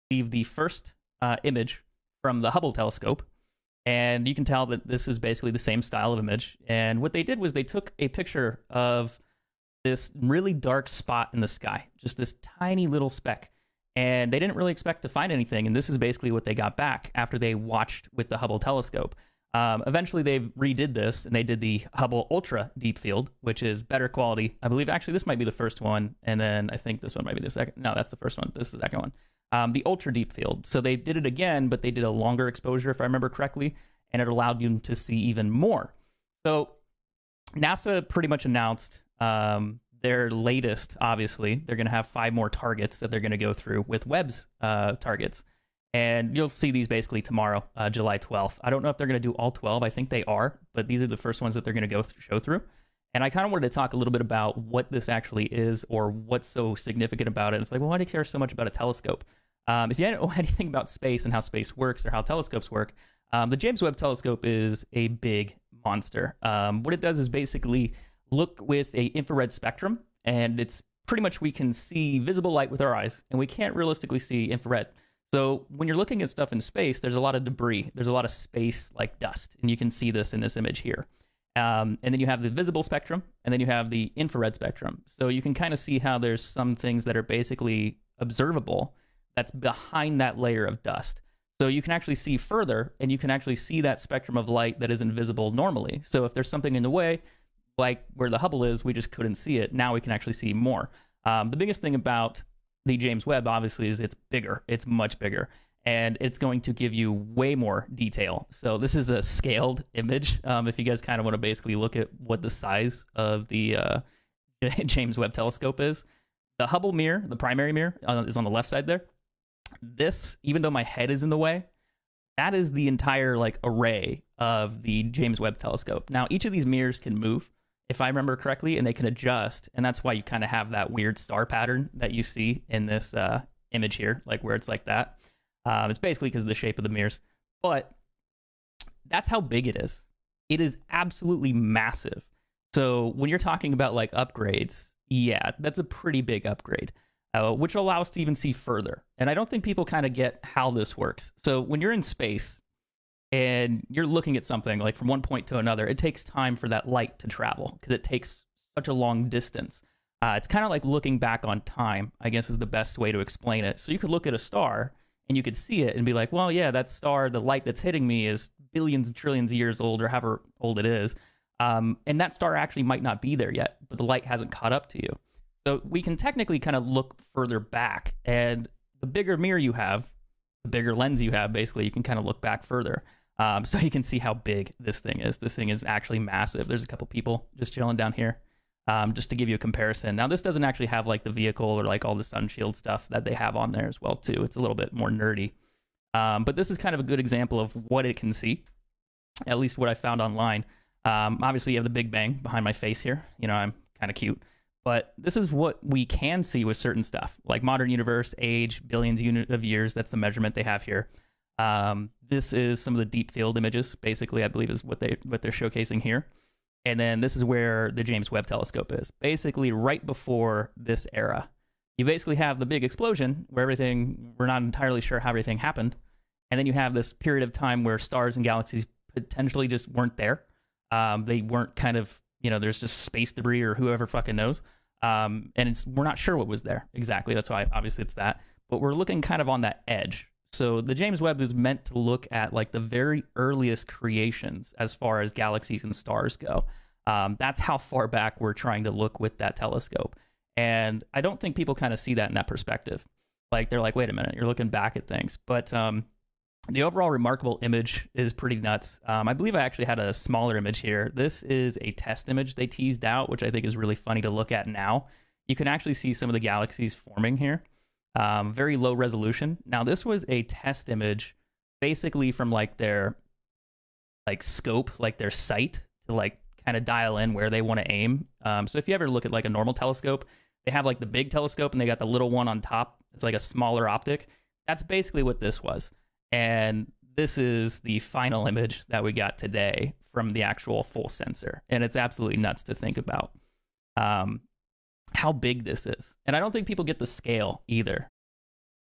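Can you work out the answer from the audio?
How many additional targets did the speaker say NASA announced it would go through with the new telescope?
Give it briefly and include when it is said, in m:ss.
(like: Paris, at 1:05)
5, at 0:42.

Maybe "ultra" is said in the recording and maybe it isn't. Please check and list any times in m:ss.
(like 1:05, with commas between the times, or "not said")
0:22, 0:29.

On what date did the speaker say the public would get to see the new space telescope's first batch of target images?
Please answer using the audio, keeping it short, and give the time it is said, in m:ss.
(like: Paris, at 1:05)
July 12th, at 0:47.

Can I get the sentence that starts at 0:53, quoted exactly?
And I kind of wanted to talk a little bit about what this actually is or what's so significant about it.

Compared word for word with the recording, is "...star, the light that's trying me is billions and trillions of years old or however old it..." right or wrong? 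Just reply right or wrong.
wrong.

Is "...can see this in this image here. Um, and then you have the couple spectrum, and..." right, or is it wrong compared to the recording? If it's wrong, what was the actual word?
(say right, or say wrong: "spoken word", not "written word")
wrong: "visible", not "couple".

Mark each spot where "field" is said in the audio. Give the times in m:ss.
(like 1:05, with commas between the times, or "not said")
0:22, 0:30, 3:33.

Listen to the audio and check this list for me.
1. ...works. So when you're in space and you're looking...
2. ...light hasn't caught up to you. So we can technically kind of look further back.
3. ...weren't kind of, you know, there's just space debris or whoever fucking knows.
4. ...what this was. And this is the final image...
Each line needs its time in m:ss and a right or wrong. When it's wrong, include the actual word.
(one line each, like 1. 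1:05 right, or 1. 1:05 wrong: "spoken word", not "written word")
1. 2:30 right
2. 2:54 right
3. 3:51 right
4. 4:45 right.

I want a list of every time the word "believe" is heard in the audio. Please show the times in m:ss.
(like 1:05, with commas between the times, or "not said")
0:00, 0:24, 3:34, 4:19.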